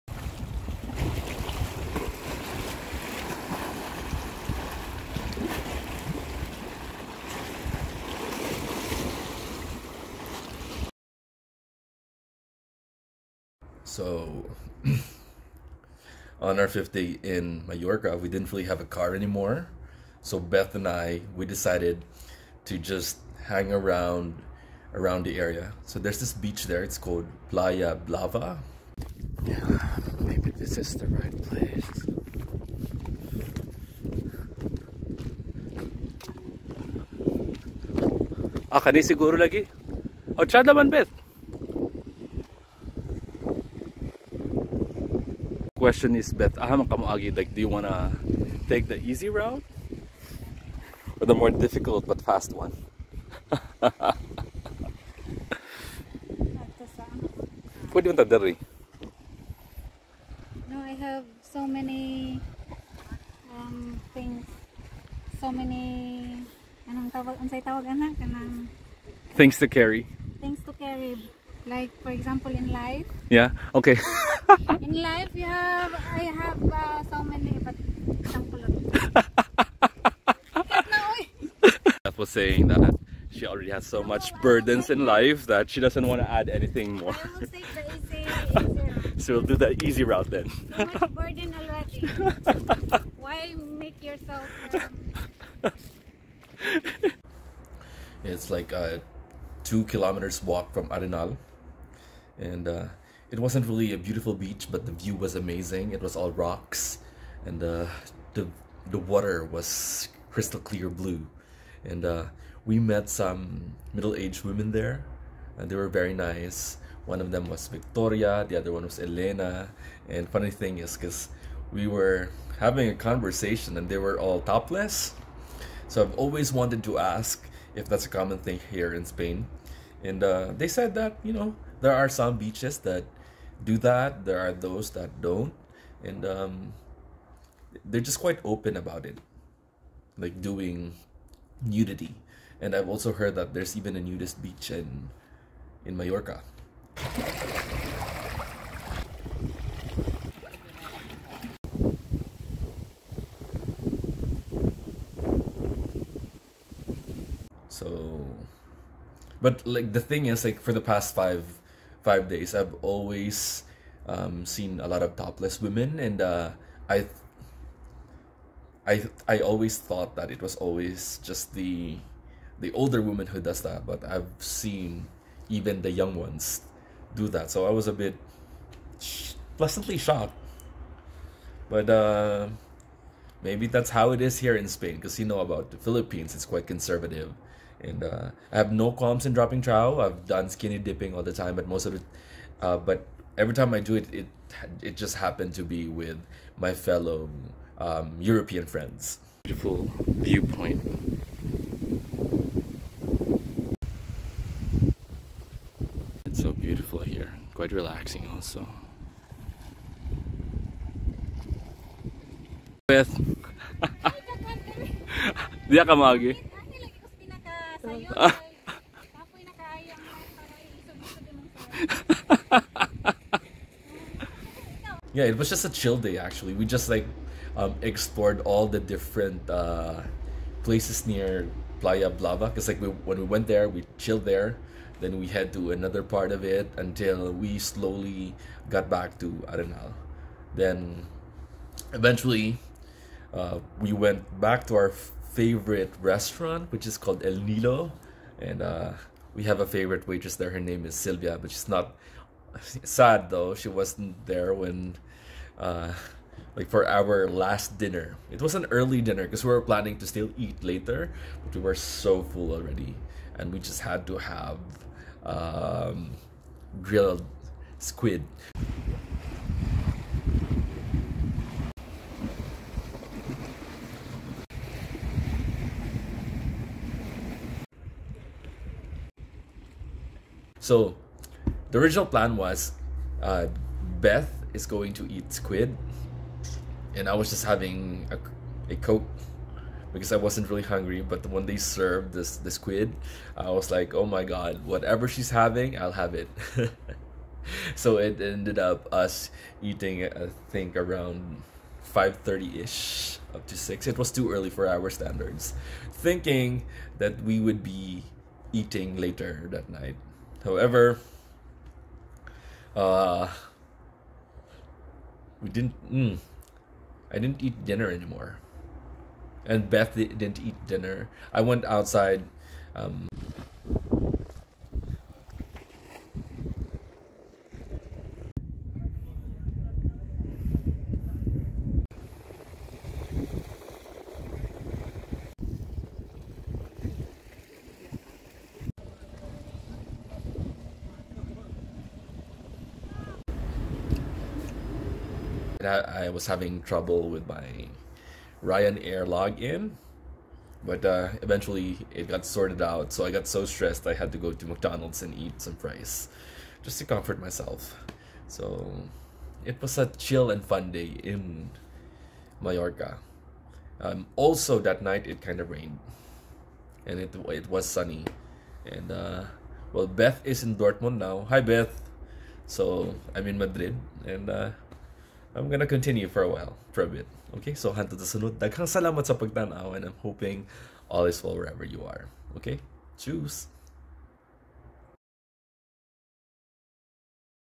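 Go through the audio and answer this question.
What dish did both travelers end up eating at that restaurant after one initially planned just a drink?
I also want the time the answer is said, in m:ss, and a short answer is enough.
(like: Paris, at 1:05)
Grilled squid, at 4:26.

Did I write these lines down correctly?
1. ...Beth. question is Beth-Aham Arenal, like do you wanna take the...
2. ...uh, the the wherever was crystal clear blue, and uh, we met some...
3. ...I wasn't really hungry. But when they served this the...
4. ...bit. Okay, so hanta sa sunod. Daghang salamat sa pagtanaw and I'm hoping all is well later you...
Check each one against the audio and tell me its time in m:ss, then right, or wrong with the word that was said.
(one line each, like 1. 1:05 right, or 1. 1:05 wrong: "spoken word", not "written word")
1. 0:40 wrong: "Kamuagi", not "Arenal"
2. 1:47 wrong: "water", not "wherever"
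3. 4:50 right
4. 6:16 wrong: "wherever", not "later".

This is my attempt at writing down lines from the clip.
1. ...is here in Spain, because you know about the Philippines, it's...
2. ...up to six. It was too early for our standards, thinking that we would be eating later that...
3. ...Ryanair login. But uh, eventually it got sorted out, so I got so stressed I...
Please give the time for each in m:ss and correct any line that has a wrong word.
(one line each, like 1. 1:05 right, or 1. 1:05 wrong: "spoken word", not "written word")
1. 3:04 right
2. 5:03 right
3. 5:48 right.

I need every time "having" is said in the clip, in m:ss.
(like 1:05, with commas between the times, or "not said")
2:02, 4:47, 4:55, 5:46.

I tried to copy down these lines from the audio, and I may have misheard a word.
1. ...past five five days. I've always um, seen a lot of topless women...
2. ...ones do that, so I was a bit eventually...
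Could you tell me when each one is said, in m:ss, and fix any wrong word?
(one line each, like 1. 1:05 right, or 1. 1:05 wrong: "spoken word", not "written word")
1. 2:40 right
2. 2:56 wrong: "pleasantly", not "eventually".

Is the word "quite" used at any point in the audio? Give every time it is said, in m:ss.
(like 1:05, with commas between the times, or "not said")
2:18, 3:06, 3:27.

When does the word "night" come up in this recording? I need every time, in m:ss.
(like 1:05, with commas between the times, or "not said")
5:09, 6:04.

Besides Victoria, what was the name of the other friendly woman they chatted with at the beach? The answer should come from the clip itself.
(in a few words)
Elena.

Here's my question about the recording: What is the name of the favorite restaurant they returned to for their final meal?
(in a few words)
El Nilo.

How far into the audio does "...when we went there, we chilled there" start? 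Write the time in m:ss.
3:52.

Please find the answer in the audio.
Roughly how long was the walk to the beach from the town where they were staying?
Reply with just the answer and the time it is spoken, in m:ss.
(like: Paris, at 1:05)
2 kilometers, at 1:39.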